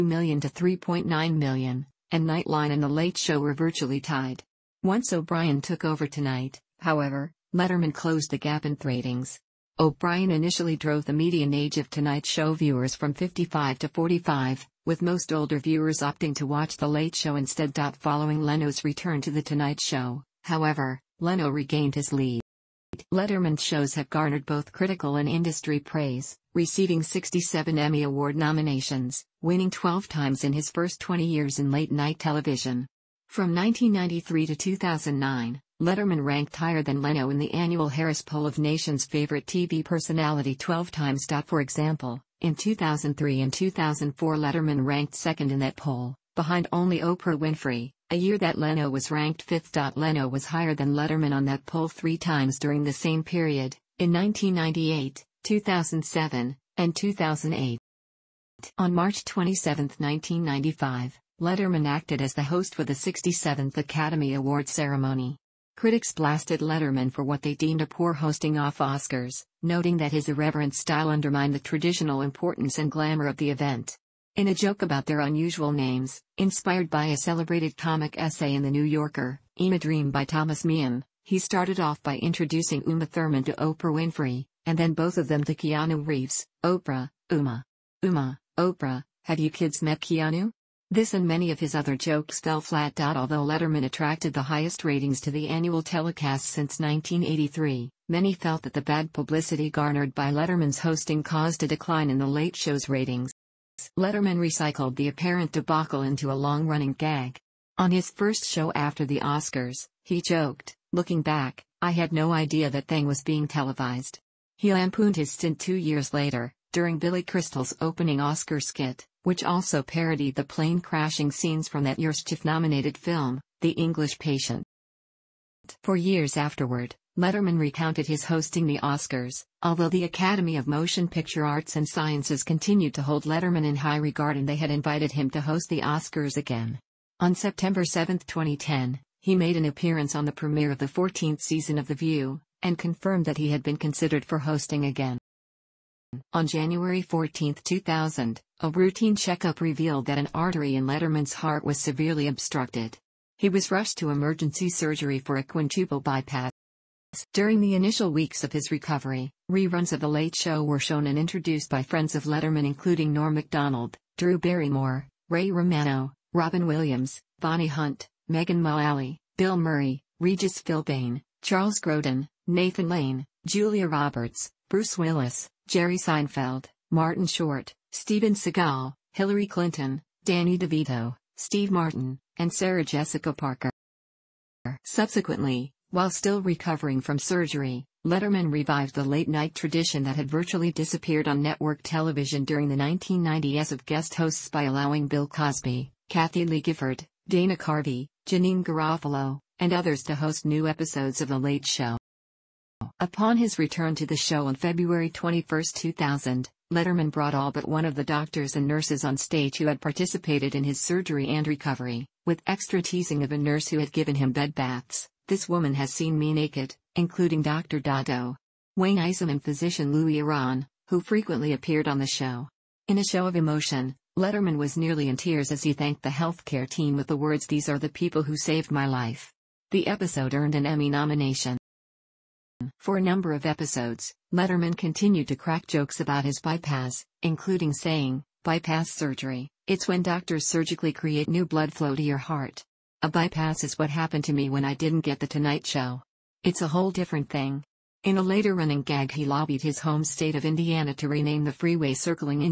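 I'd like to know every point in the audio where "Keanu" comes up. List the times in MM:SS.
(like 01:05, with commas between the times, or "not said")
01:25, 01:30.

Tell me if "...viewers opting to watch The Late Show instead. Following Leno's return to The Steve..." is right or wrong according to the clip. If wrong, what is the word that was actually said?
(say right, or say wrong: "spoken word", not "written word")
wrong: "Tonight", not "Steve".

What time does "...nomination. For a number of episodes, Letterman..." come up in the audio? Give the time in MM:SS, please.
03:50.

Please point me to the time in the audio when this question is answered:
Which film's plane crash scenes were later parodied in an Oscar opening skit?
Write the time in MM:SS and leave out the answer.
02:03.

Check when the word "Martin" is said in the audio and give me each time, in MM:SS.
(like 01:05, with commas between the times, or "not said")
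02:56, 03:01.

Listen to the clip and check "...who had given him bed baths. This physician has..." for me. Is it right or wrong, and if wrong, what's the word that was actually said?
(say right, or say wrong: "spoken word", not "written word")
wrong: "woman", not "physician".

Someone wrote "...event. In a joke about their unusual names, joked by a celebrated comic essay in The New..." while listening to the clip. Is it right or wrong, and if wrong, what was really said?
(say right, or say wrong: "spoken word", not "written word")
wrong: "inspired", not "joked".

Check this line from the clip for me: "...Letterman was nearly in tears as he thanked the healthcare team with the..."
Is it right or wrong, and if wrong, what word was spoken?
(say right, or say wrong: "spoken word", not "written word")
right.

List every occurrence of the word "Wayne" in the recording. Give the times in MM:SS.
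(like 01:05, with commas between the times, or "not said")
03:38.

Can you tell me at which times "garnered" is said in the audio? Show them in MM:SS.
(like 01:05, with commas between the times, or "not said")
00:24, 01:39.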